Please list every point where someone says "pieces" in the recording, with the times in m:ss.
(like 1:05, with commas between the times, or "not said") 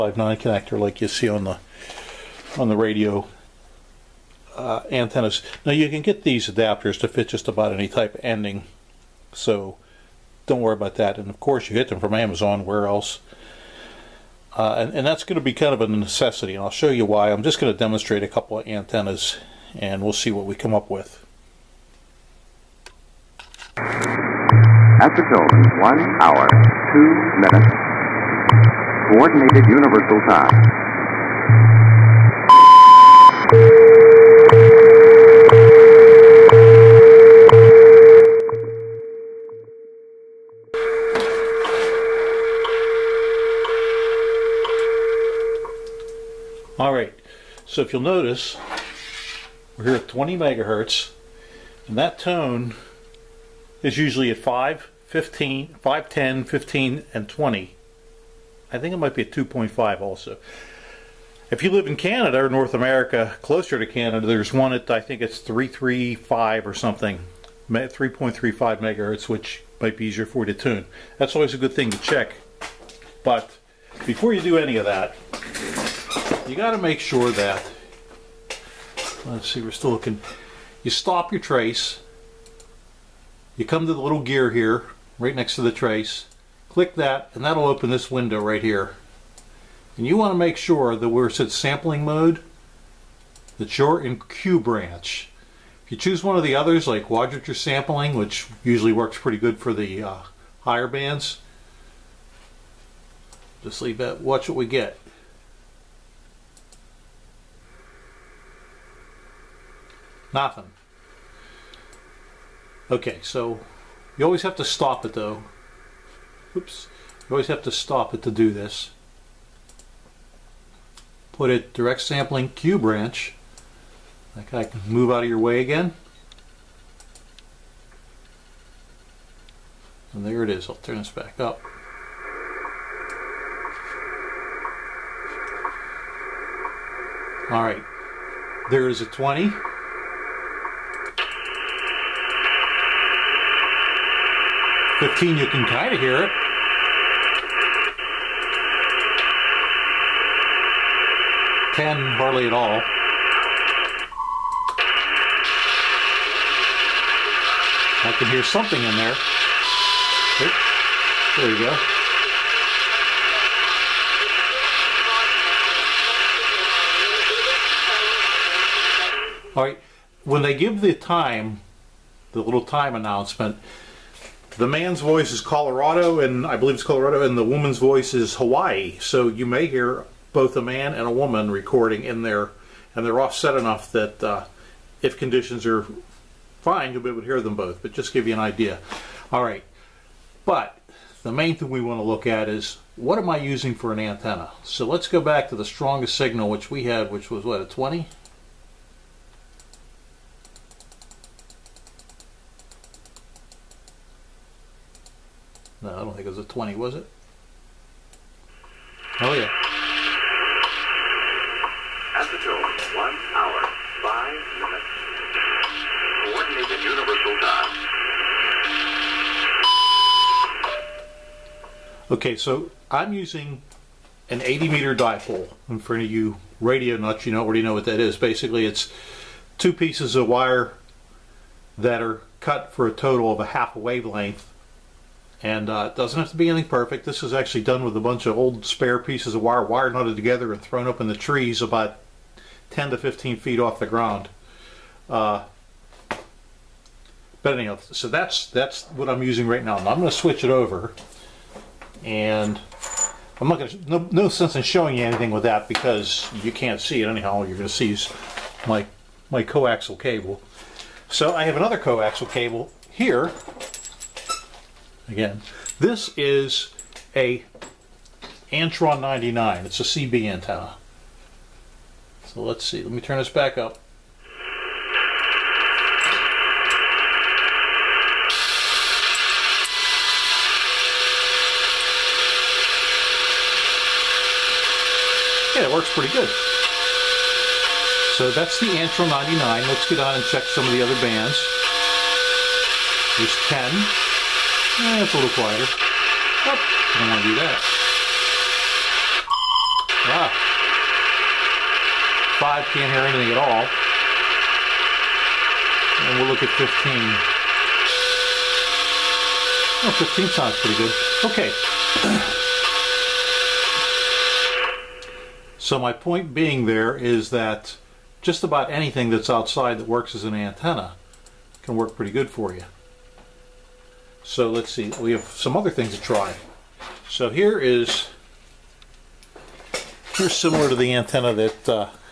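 3:49, 3:58.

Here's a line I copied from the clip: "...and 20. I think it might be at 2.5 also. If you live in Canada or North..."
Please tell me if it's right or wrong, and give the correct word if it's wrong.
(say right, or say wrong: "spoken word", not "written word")
right.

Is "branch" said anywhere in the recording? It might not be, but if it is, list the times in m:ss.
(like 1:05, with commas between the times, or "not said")
1:34, 2:02.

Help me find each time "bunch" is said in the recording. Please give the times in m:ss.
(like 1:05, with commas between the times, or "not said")
3:58.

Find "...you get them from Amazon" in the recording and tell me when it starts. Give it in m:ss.
0:11.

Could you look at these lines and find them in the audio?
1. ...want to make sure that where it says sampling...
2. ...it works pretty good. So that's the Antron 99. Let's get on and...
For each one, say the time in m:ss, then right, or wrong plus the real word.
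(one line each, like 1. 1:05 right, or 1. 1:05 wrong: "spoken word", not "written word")
1. 1:30 right
2. 4:45 right.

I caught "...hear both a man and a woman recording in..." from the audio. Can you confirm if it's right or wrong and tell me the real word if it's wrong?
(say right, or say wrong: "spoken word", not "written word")
right.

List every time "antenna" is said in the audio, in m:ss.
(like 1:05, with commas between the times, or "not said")
0:04, 0:18, 3:13, 4:30, 5:20, 5:30.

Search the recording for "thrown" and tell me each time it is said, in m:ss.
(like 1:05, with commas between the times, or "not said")
4:00.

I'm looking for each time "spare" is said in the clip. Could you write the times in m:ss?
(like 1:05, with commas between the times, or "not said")
3:58.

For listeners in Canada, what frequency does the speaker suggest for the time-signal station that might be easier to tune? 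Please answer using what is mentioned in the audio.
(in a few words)
3.35 megahertz.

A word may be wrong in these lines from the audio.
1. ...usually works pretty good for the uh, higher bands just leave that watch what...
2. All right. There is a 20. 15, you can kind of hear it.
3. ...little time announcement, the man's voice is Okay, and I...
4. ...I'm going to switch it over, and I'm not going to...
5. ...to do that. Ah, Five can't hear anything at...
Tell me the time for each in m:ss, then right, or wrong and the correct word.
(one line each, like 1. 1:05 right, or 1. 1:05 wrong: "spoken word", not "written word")
1. 1:38 right
2. 2:17 right
3. 2:52 wrong: "Colorado", not "Okay"
4. 4:09 right
5. 4:57 right.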